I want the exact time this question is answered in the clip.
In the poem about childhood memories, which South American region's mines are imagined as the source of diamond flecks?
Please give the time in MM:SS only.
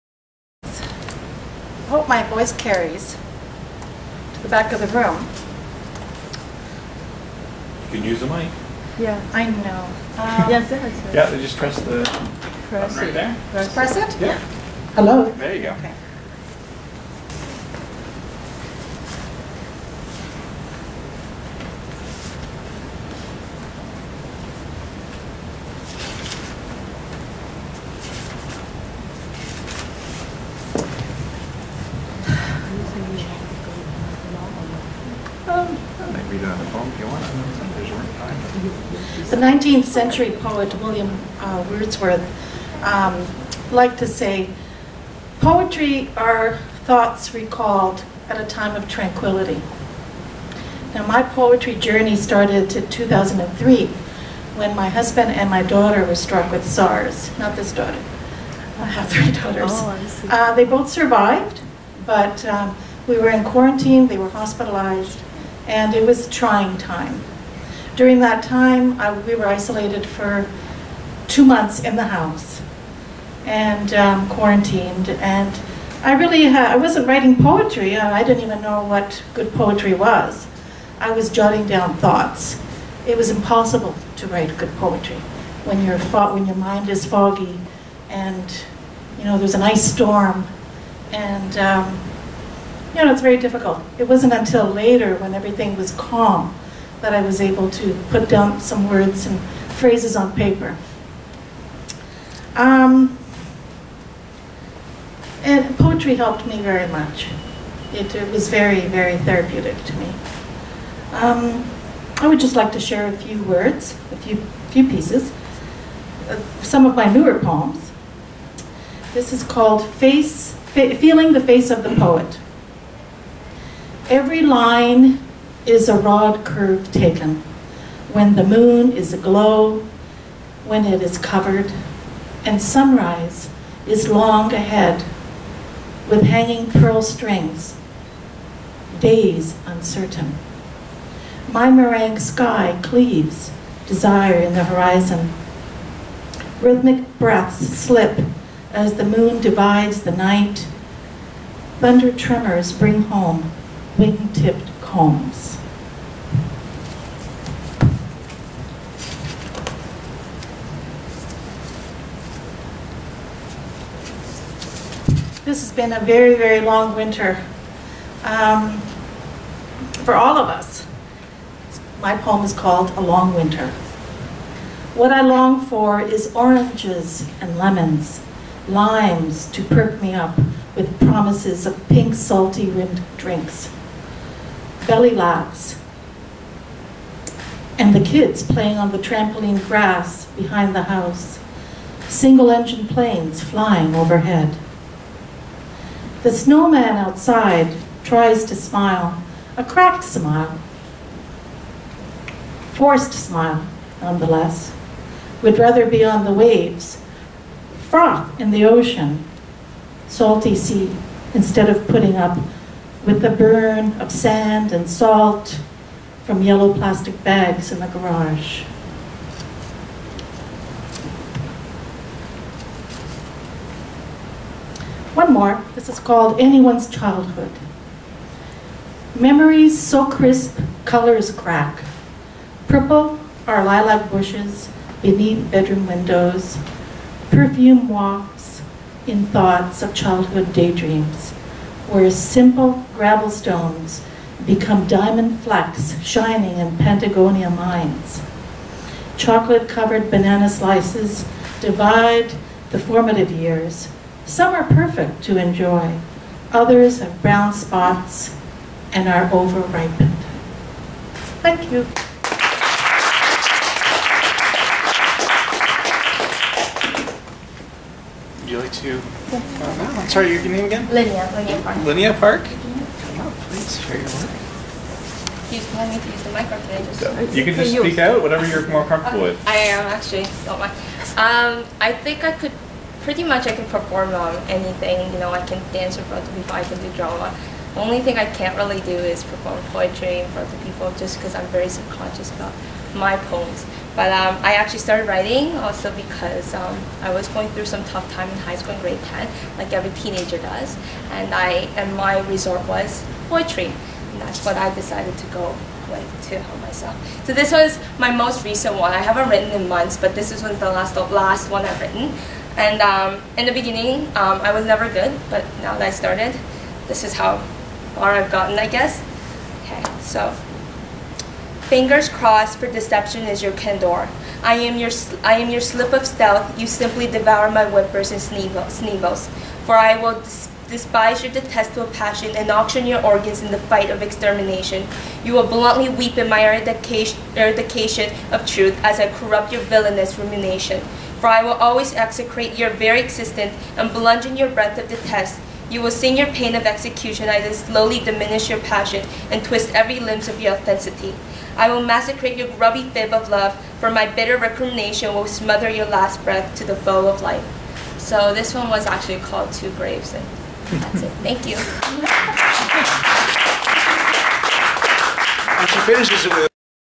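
04:06.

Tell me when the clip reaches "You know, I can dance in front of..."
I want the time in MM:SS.
04:45.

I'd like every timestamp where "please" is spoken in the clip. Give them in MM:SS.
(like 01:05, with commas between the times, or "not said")
04:33.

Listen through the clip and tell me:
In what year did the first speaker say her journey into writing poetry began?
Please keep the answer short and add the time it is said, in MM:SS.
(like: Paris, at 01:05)
2003, at 00:52.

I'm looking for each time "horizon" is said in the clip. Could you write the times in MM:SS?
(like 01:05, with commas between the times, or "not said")
02:24.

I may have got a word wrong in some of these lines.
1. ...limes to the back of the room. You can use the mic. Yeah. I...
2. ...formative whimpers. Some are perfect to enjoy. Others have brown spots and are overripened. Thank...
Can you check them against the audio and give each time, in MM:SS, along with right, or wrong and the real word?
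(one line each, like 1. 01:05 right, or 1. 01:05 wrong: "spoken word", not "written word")
1. 00:02 wrong: "carries", not "limes"
2. 04:12 wrong: "years", not "whimpers".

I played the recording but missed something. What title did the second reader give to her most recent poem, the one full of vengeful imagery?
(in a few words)
Two Graves.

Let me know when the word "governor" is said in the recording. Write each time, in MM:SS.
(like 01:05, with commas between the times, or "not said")
not said.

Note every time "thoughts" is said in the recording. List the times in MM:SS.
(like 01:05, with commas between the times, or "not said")
00:46, 01:21, 03:59.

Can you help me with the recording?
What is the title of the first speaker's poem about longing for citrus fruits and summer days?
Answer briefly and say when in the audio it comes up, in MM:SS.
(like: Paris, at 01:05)
A Long Winter, at 02:52.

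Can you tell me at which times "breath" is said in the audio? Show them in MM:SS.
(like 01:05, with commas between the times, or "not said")
02:27, 05:44, 05:56.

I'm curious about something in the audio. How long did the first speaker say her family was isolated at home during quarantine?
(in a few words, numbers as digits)
two months.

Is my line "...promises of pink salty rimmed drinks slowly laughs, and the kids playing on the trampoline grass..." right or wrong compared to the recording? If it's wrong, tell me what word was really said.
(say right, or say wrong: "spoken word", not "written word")
wrong: "belly", not "slowly".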